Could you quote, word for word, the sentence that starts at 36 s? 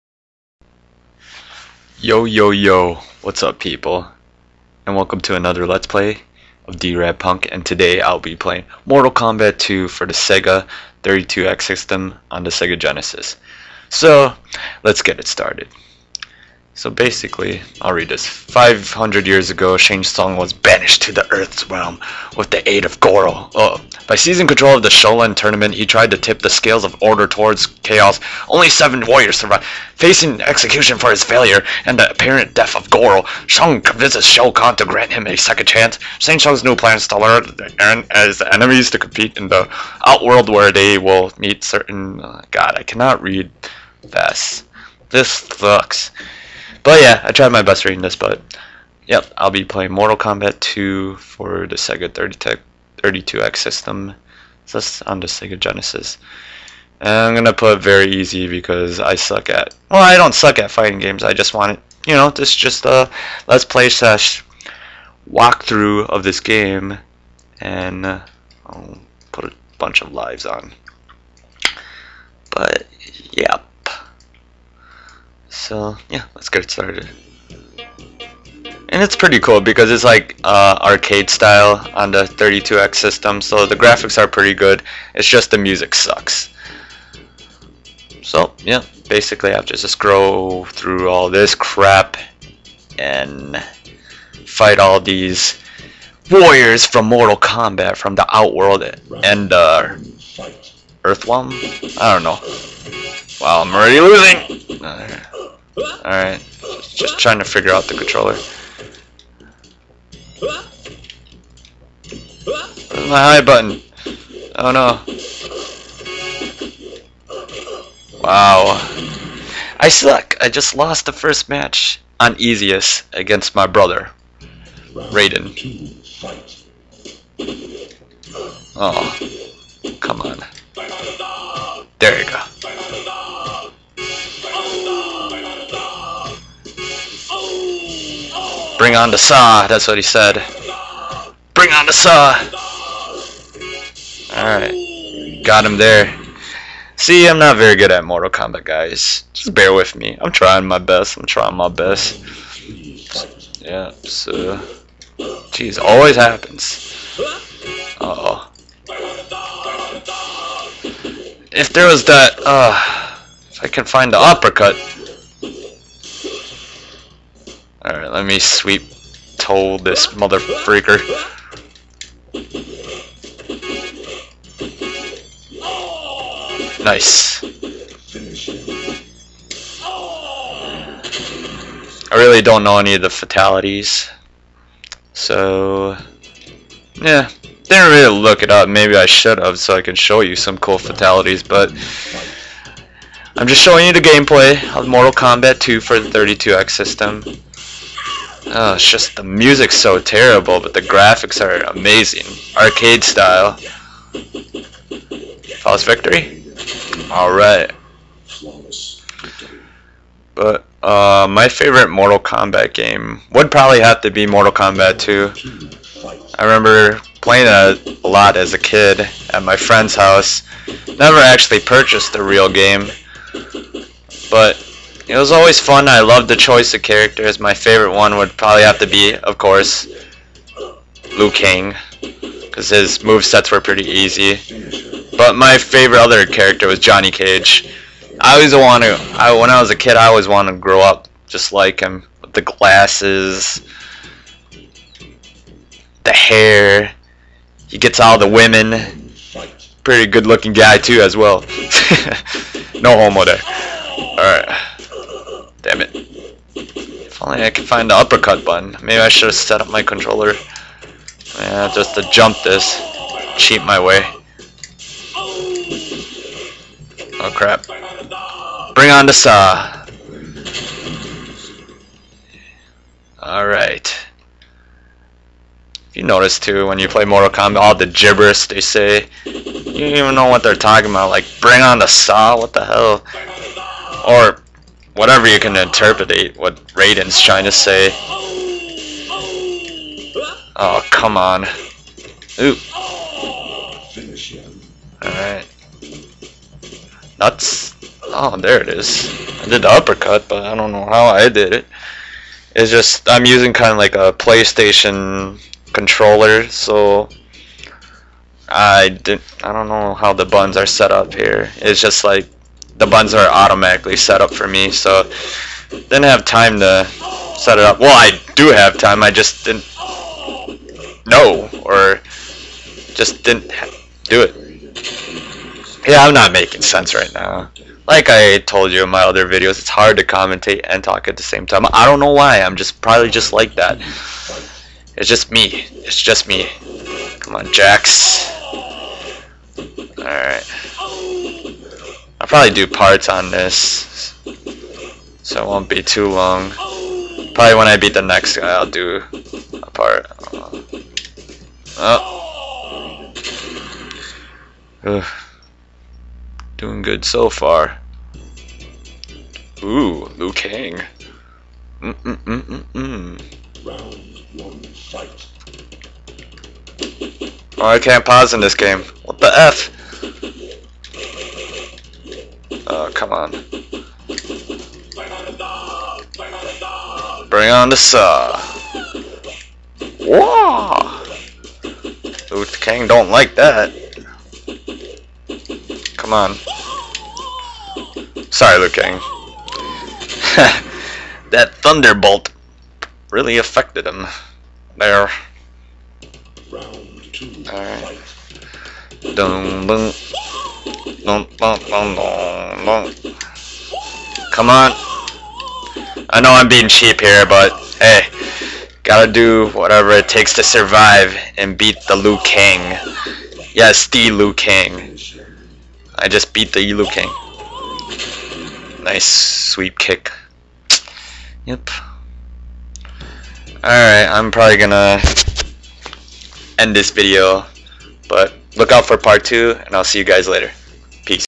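Shang Tsung's new plans to alert Eren as the enemies to compete in the outworld where they will meet certain...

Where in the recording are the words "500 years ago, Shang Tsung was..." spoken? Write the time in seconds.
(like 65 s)
18 s.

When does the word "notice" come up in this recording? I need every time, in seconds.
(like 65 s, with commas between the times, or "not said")
276 s.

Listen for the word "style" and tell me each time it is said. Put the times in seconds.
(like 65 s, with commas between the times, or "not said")
81 s, 203 s.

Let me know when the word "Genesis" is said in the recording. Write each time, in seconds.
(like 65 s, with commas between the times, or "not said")
12 s, 55 s.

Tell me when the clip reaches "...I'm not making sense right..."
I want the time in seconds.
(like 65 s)
325 s.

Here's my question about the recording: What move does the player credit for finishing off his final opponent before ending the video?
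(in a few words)
Sweep kick.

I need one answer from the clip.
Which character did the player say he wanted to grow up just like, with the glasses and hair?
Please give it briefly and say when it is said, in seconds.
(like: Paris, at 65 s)
Johnny Cage, at 236 s.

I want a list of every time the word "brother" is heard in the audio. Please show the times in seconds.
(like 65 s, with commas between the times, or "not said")
123 s.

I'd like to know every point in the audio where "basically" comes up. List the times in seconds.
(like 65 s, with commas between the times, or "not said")
16 s, 89 s.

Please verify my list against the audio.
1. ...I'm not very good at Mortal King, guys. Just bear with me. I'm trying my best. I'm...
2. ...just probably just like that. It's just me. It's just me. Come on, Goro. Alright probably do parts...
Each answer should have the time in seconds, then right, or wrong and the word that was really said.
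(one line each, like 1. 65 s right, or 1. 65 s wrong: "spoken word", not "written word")
1. 147 s wrong: "Kombat", not "King"
2. 332 s wrong: "Jax", not "Goro".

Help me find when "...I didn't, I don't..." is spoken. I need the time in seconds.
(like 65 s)
308 s.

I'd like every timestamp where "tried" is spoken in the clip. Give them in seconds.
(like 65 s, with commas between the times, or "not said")
25 s, 47 s.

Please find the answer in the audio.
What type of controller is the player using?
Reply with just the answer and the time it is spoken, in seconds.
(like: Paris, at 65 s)
PlayStation controller, at 304 s.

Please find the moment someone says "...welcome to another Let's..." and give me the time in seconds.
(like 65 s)
4 s.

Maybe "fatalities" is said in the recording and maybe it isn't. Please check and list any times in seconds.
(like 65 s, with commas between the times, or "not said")
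183 s, 190 s.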